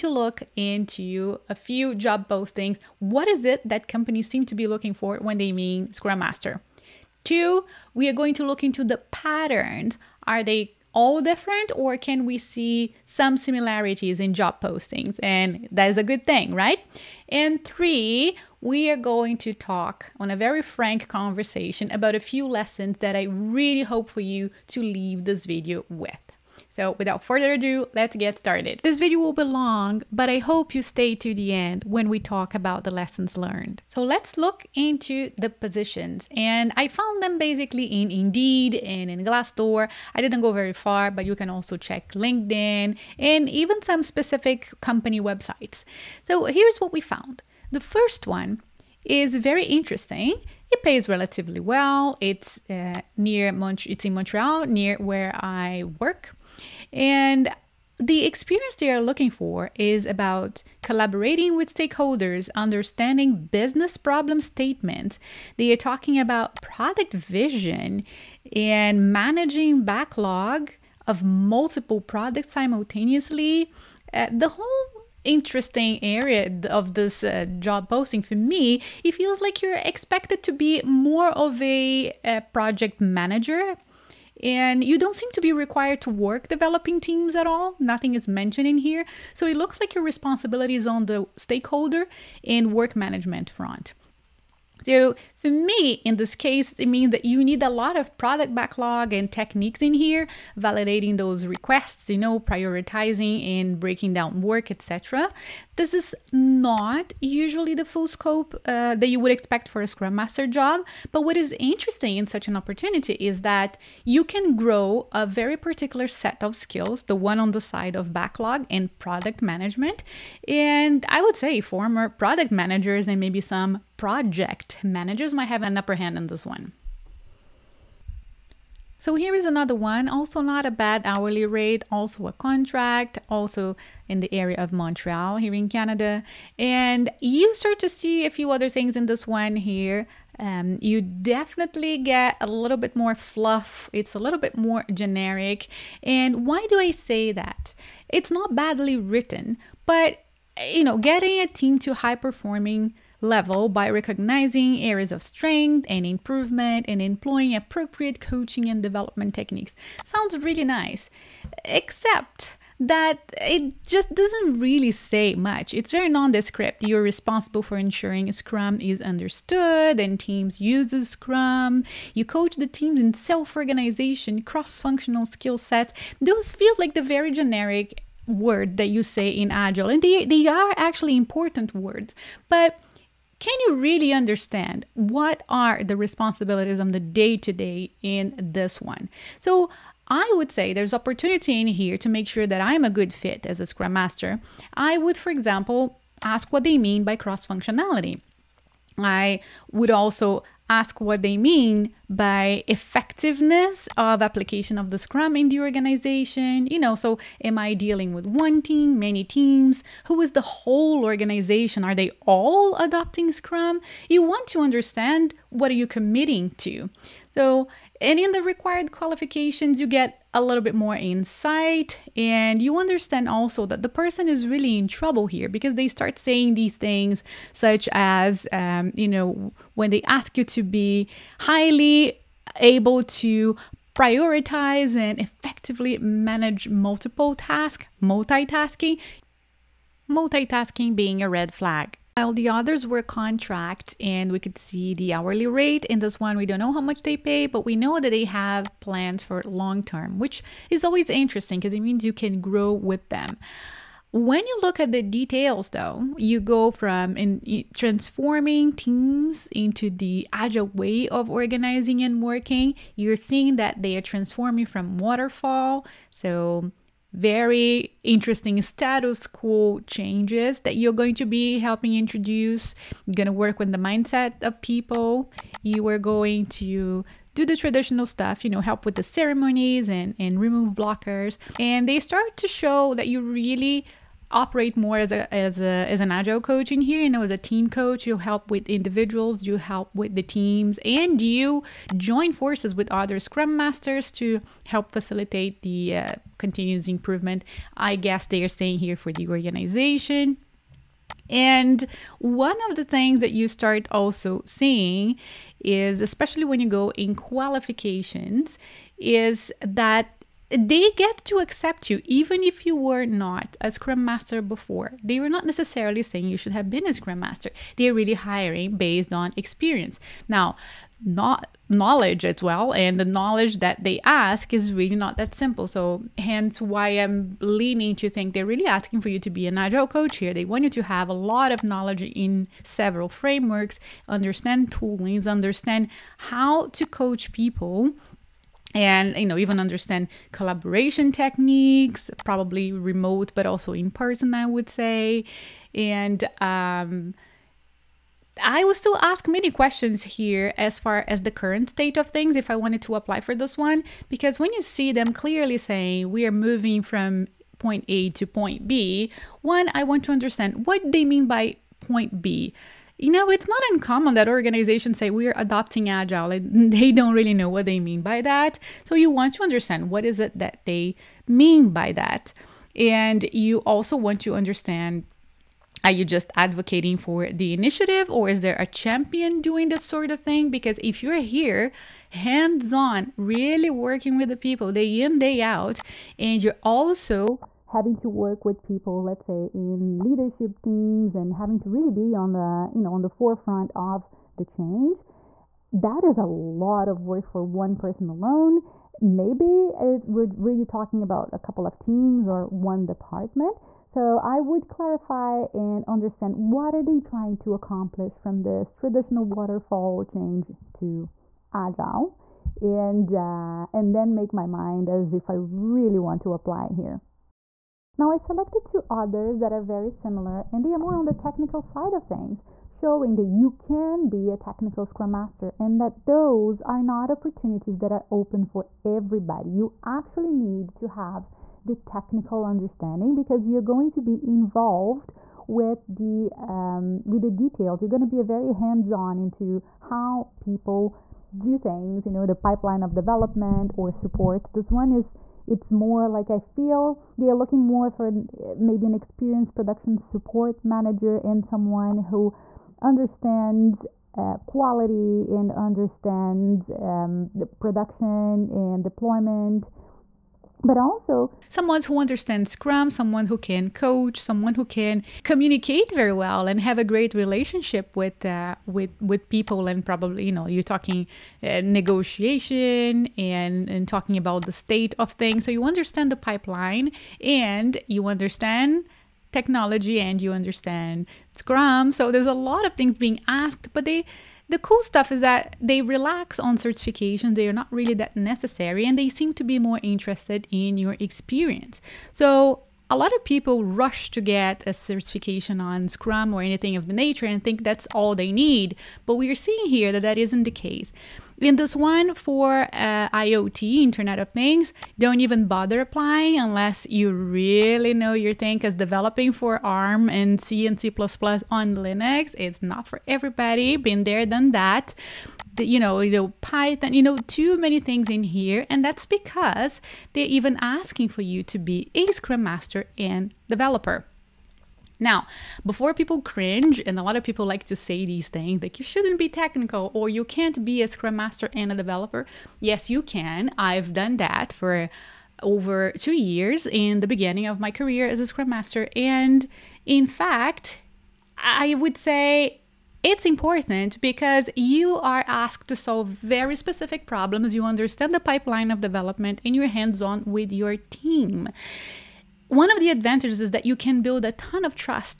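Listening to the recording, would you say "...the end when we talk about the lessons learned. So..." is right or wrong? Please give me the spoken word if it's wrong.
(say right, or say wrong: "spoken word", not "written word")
right.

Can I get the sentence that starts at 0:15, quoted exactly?
And that is a good thing, right?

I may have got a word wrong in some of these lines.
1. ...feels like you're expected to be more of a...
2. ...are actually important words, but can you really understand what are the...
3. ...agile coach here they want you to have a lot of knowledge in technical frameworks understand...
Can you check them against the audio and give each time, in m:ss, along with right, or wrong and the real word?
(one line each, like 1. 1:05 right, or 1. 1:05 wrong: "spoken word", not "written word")
1. 1:19 right
2. 3:00 right
3. 5:29 wrong: "several", not "technical".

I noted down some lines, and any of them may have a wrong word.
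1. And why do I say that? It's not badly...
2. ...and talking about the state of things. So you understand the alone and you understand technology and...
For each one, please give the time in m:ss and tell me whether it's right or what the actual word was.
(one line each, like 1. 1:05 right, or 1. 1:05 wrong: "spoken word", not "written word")
1. 2:26 right
2. 7:53 wrong: "pipeline", not "alone".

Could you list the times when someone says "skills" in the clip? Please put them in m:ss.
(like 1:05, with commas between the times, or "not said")
1:56, 2:55.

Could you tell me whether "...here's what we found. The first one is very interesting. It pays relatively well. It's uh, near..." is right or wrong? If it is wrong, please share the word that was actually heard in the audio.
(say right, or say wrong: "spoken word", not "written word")
right.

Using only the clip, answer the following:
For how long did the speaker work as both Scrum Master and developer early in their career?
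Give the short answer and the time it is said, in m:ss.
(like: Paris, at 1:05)
Over 2 years, at 8:55.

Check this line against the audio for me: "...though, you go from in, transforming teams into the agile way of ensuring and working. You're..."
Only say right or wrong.
wrong.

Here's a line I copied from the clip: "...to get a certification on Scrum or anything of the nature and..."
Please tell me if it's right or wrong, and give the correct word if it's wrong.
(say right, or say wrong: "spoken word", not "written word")
right.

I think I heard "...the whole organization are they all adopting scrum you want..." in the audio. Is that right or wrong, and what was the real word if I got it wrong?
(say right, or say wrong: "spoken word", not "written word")
right.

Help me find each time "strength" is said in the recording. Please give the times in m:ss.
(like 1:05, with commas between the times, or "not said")
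2:35.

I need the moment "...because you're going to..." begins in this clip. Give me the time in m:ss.
7:13.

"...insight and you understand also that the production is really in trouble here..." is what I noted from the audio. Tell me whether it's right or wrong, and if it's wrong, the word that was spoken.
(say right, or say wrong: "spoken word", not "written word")
wrong: "person", not "production".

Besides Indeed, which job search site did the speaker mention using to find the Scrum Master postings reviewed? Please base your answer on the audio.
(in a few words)
Glassdoor.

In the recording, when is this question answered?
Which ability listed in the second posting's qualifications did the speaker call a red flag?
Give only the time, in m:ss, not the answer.
4:00.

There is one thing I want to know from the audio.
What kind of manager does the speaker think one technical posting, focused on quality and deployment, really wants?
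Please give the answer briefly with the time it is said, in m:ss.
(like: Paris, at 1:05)
Production support manager, at 7:29.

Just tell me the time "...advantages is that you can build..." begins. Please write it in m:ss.
9:12.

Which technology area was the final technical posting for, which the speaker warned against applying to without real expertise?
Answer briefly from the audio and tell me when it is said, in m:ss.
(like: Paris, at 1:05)
Internet of Things, at 8:23.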